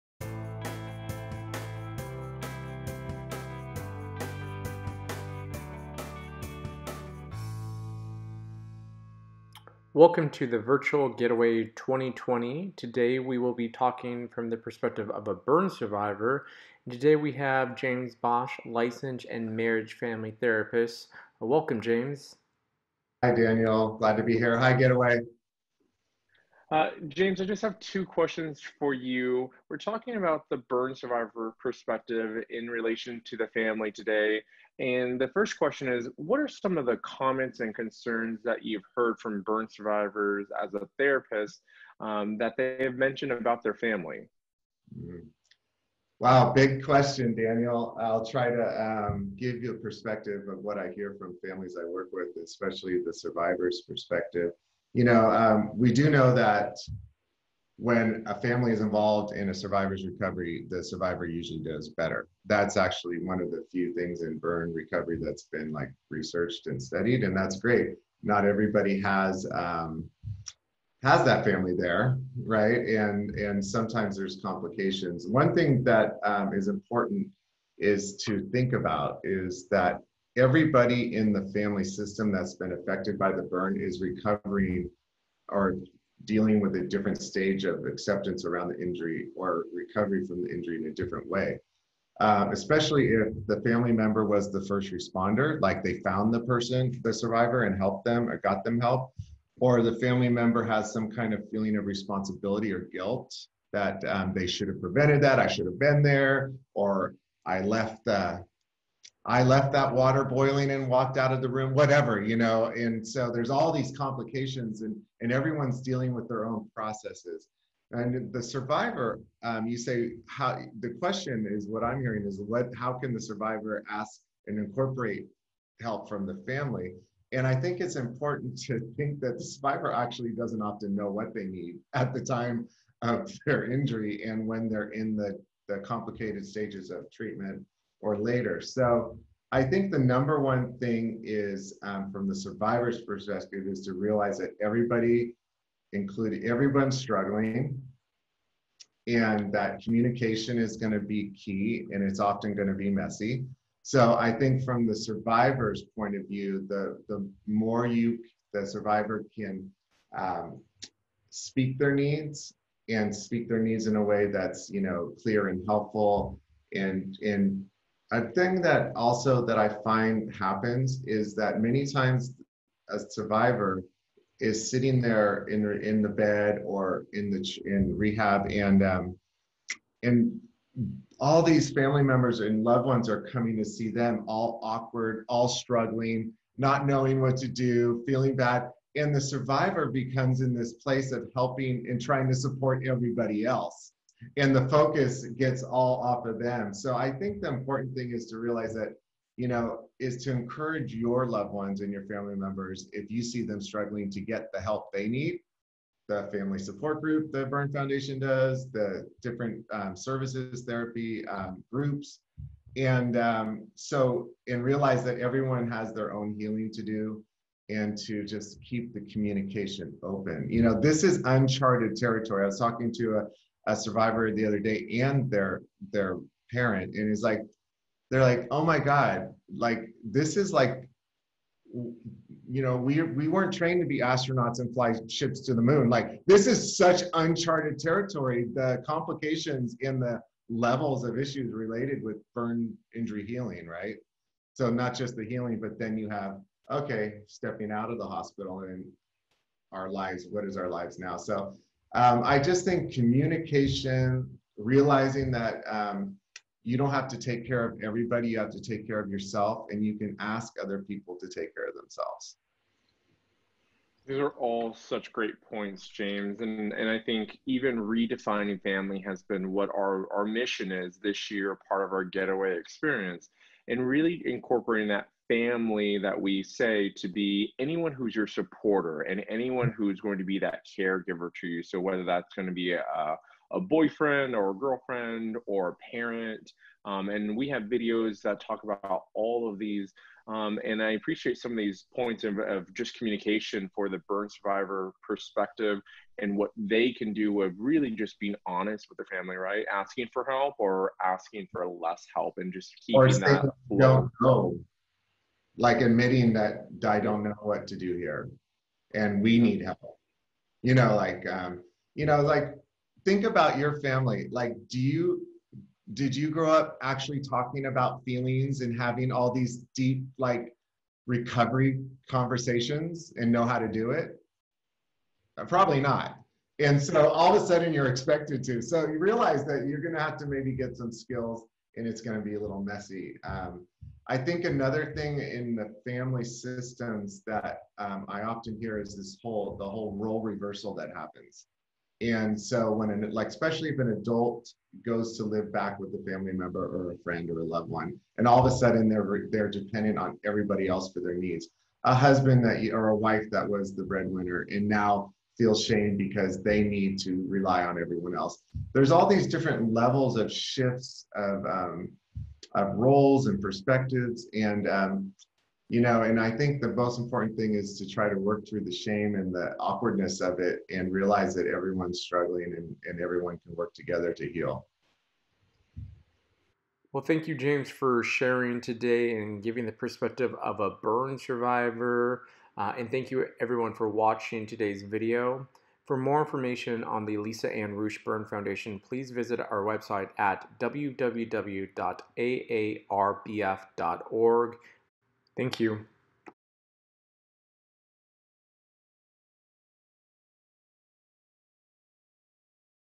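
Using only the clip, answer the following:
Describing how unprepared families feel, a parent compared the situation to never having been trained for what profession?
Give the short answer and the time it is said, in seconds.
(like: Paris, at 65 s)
astronauts, at 234 s.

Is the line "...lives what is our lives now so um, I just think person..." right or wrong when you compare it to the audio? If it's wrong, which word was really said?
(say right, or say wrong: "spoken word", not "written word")
wrong: "communication", not "person".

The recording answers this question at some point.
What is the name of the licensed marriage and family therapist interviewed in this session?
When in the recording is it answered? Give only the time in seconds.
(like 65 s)
17 s.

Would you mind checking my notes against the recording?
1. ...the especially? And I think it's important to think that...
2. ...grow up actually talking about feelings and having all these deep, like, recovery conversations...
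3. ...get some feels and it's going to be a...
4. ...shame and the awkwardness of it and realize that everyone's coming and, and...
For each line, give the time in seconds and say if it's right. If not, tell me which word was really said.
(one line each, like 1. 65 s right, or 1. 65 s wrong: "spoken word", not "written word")
1. 126 s wrong: "family", not "especially"
2. 316 s right
3. 330 s wrong: "skills", not "feels"
4. 368 s wrong: "struggling", not "coming".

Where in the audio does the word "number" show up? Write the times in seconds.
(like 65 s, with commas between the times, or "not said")
139 s.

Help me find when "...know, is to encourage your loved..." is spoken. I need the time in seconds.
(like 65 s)
199 s.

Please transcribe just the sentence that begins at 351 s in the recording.
A husband that or a wife that was the breadwinner and now feels shame because they need to rely on everyone else.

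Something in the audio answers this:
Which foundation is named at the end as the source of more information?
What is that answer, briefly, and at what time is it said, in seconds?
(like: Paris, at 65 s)
Alisa Ann Ruch Burn Foundation, at 387 s.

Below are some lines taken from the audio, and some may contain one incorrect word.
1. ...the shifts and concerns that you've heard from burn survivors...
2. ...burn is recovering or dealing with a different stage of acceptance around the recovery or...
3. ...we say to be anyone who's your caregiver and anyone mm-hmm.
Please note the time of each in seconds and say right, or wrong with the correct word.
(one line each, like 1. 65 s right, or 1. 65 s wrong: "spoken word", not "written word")
1. 36 s wrong: "comments", not "shifts"
2. 83 s wrong: "injury", not "recovery"
3. 276 s wrong: "supporter", not "caregiver".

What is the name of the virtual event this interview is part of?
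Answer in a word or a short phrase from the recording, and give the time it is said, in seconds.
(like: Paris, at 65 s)
Virtual Getaway 2020, at 10 s.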